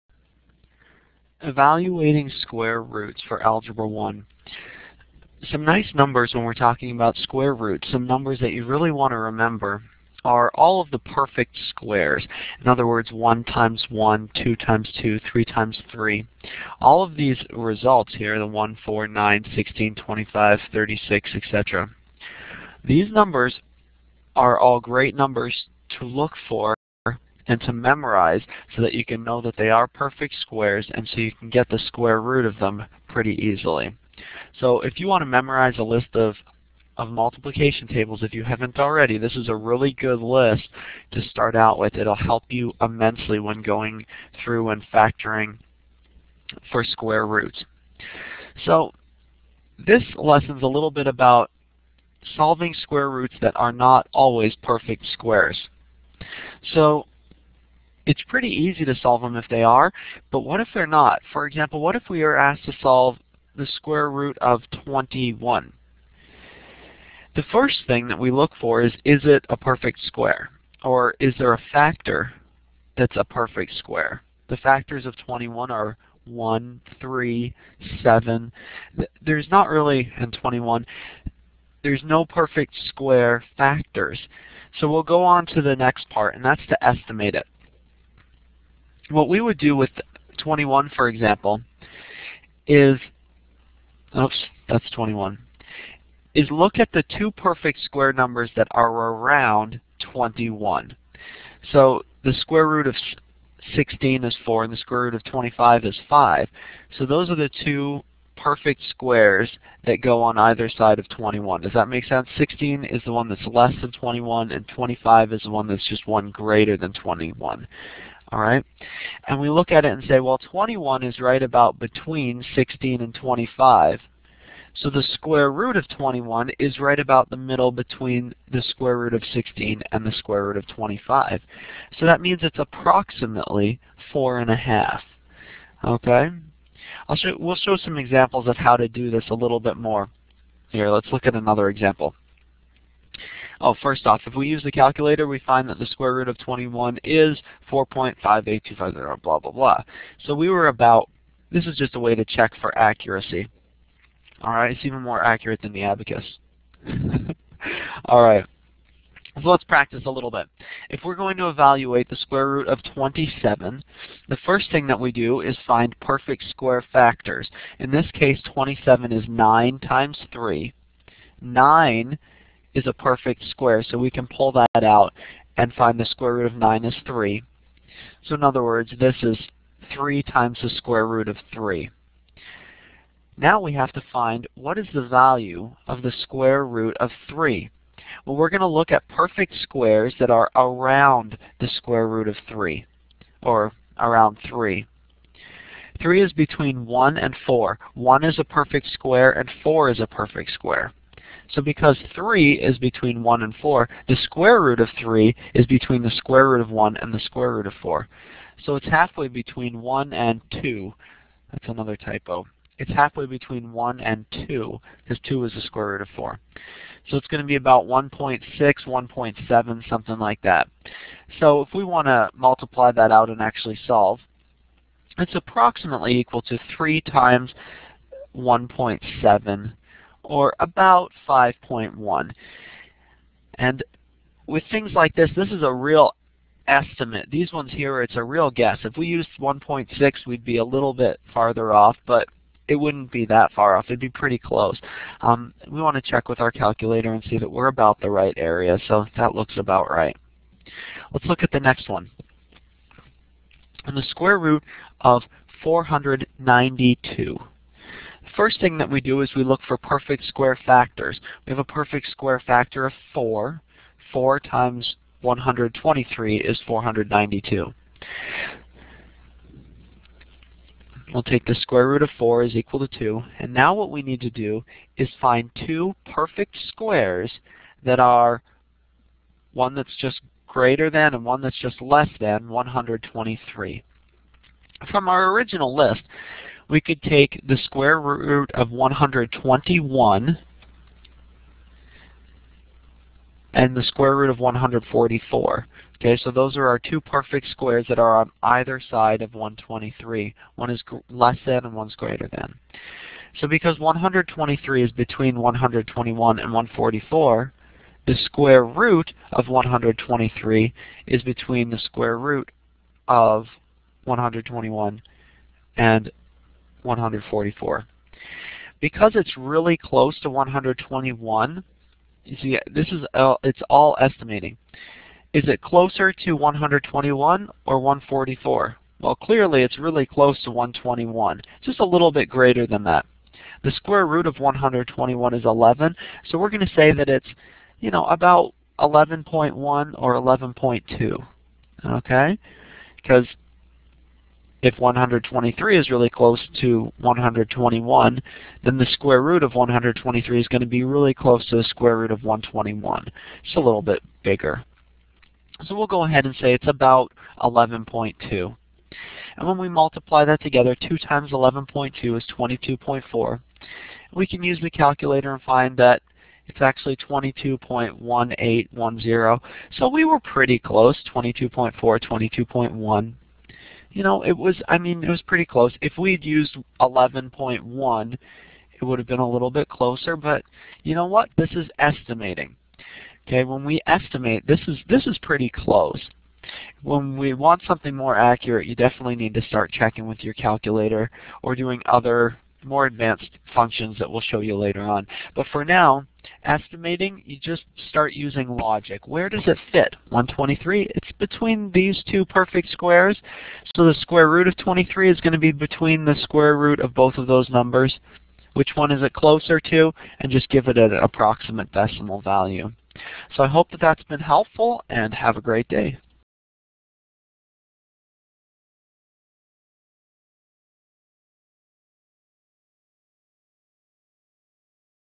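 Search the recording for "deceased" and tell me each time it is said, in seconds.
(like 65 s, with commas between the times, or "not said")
not said.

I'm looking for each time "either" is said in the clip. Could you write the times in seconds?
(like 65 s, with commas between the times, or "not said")
110 s, 298 s.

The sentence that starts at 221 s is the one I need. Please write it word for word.
So if we want to multiply that out and actually solve, it's approximately equal to 3 times 1.7 or about 5.1.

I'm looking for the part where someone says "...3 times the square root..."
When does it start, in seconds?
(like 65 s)
179 s.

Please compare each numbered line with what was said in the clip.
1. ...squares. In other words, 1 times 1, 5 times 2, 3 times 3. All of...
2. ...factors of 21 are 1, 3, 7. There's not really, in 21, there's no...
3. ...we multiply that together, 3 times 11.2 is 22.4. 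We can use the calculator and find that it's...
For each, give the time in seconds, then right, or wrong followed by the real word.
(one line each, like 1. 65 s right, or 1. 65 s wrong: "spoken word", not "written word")
1. 11 s wrong: "2", not "5"
2. 74 s right
3. 359 s wrong: "2", not "3".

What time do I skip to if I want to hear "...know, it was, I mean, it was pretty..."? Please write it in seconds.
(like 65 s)
374 s.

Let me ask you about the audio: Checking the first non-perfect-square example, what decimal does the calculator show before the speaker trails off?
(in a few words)
4.58250.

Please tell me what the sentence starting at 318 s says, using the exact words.
Because it's really close to 121, you see, this is uh, it's all estimating.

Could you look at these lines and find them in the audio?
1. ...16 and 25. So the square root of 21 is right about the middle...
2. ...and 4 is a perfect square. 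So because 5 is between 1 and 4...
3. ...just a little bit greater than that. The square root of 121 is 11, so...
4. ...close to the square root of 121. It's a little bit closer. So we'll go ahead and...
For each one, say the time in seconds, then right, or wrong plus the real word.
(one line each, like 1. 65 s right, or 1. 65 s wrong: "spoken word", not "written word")
1. 122 s right
2. 199 s wrong: "3", not "5"
3. 331 s right
4. 351 s wrong: "bigger", not "closer".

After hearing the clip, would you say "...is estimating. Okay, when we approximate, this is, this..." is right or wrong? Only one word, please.
wrong.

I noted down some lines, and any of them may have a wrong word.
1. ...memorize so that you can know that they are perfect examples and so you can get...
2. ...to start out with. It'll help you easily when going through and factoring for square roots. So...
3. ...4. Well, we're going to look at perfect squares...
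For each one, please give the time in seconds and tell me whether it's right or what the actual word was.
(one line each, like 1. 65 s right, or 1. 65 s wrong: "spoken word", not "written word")
1. 27 s wrong: "squares", not "examples"
2. 41 s wrong: "immensely", not "easily"
3. 187 s wrong: "3", not "4".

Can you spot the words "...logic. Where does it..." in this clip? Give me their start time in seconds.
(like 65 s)
398 s.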